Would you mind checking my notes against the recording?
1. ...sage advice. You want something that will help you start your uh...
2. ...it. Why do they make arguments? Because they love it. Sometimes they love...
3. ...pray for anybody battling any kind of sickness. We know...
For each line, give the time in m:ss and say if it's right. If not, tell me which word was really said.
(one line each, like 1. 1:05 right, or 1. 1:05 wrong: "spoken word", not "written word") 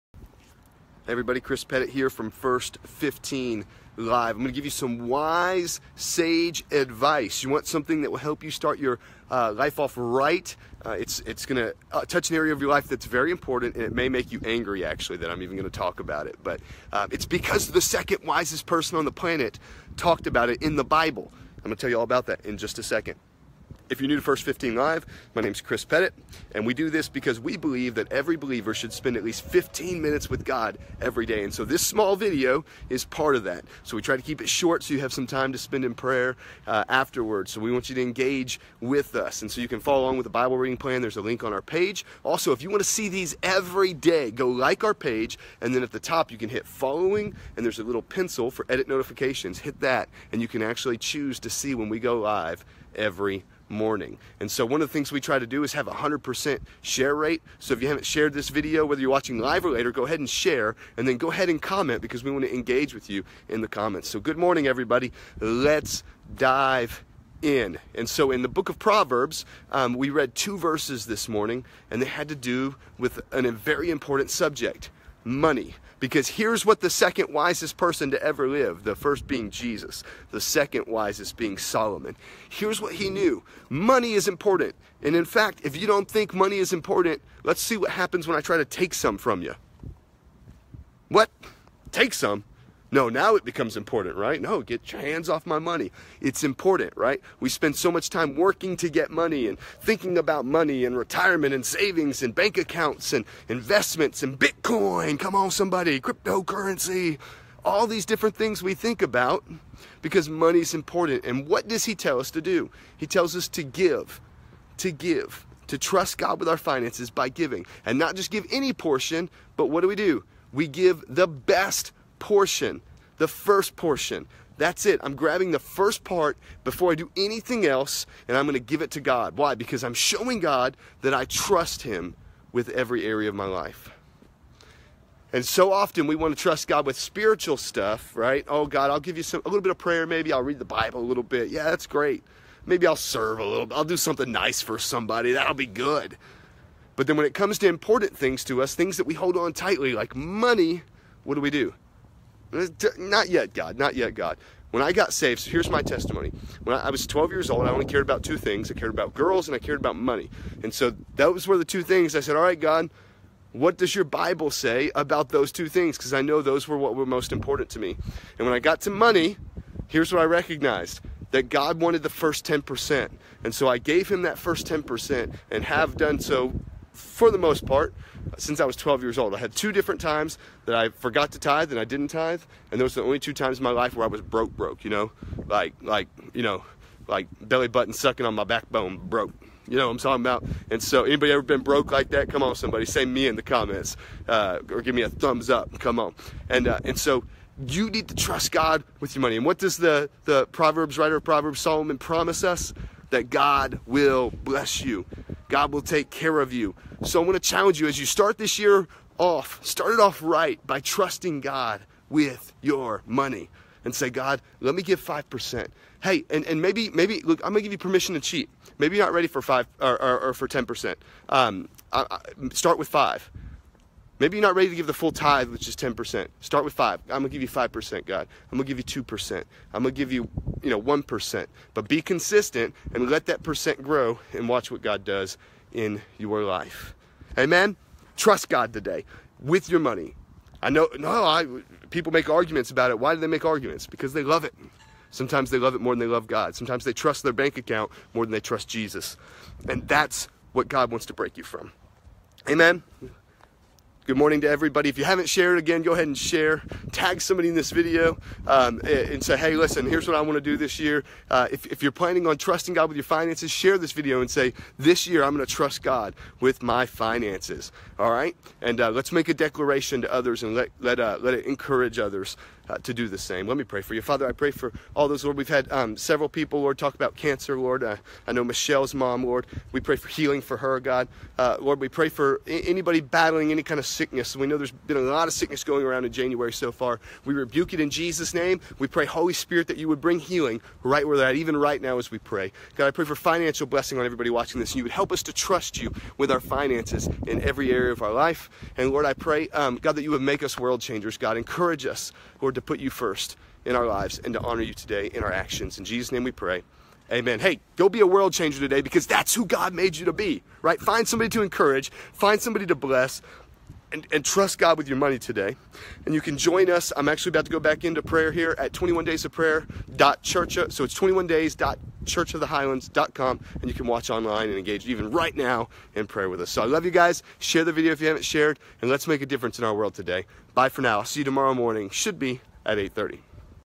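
1. 0:05 right
2. 4:02 right
3. 4:41 right.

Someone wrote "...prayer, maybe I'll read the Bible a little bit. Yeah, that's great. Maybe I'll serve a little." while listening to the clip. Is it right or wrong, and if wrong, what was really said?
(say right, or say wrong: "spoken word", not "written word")
right.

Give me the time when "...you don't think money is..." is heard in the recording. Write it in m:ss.
1:25.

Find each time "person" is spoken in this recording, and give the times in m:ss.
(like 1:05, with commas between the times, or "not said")
0:18, 1:17.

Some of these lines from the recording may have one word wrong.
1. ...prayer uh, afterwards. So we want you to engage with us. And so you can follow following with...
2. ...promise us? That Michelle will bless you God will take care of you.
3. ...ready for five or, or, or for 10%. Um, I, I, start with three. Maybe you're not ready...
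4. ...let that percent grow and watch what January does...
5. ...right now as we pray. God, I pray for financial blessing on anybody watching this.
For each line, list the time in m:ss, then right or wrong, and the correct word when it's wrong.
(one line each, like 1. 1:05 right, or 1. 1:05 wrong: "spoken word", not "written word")
1. 0:35 wrong: "along", not "following"
2. 3:21 wrong: "God", not "Michelle"
3. 3:39 wrong: "five", not "three"
4. 3:53 wrong: "God", not "January"
5. 4:51 wrong: "everybody", not "anybody".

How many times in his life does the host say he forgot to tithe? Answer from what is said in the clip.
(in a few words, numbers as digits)
2.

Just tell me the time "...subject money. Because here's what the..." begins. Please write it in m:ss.
1:14.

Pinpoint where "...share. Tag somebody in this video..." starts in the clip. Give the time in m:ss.
4:16.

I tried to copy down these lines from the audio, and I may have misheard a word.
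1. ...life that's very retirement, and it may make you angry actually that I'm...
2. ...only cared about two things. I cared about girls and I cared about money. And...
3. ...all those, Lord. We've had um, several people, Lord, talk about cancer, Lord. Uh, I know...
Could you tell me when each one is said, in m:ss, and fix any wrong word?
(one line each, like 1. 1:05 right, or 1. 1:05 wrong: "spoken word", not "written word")
1. 0:12 wrong: "important", not "retirement"
2. 2:37 right
3. 4:34 right.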